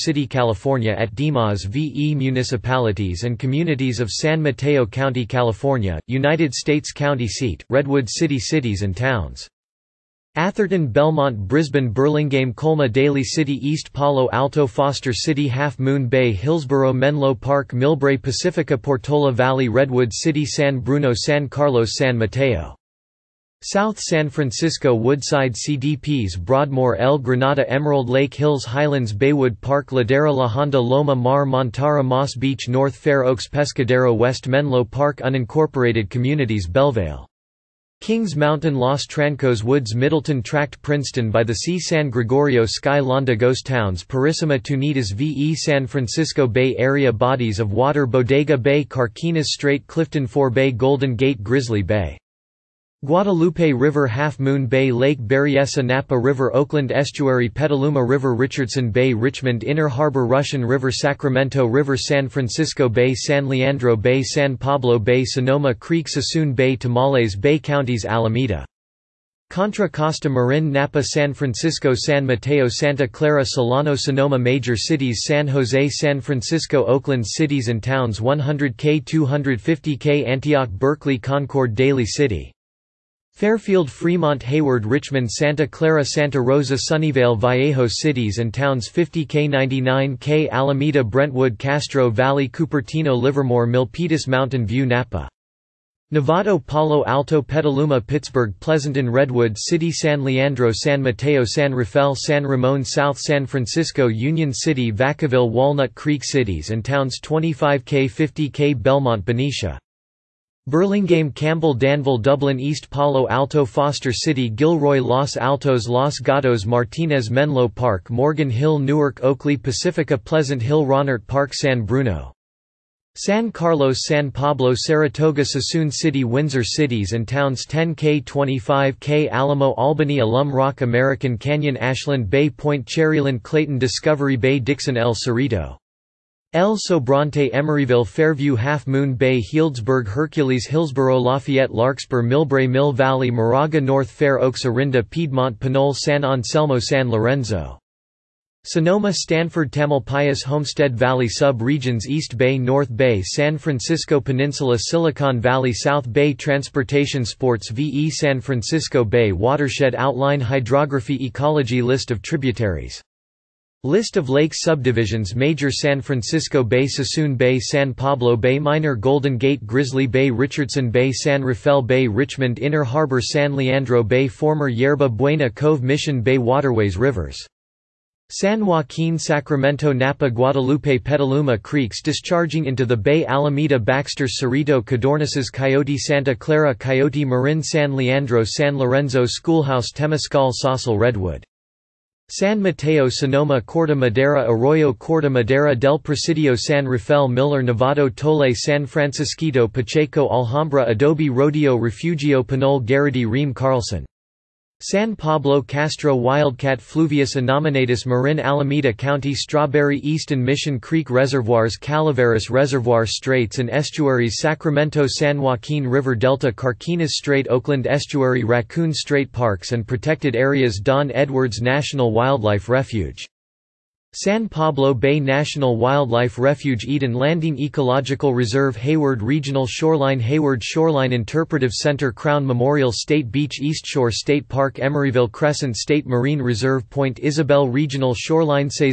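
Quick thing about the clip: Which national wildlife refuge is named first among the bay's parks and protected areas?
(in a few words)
Don Edwards National Wildlife Refuge.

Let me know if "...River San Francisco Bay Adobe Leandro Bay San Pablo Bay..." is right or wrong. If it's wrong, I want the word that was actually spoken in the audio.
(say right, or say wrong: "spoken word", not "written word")
wrong: "San", not "Adobe".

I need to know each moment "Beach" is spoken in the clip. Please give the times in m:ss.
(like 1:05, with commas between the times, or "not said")
0:32, 3:53.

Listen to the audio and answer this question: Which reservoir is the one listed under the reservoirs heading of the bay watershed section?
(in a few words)
Calaveras Reservoir.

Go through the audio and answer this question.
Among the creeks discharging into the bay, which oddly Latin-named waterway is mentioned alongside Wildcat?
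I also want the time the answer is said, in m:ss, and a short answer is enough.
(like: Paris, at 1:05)
Fluvius Innominatus, at 3:26.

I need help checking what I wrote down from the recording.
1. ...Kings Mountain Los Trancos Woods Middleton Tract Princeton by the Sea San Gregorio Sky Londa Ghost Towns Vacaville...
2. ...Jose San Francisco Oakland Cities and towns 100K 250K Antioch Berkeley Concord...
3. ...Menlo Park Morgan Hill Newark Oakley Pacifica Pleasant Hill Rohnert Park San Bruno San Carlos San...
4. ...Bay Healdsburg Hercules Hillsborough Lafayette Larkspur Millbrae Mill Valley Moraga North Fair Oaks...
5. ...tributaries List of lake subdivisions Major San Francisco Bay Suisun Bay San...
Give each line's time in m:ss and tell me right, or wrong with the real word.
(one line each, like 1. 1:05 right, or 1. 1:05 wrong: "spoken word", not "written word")
1. 0:38 wrong: "Purisima", not "Vacaville"
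2. 1:15 right
3. 1:57 right
4. 2:19 right
5. 2:42 right.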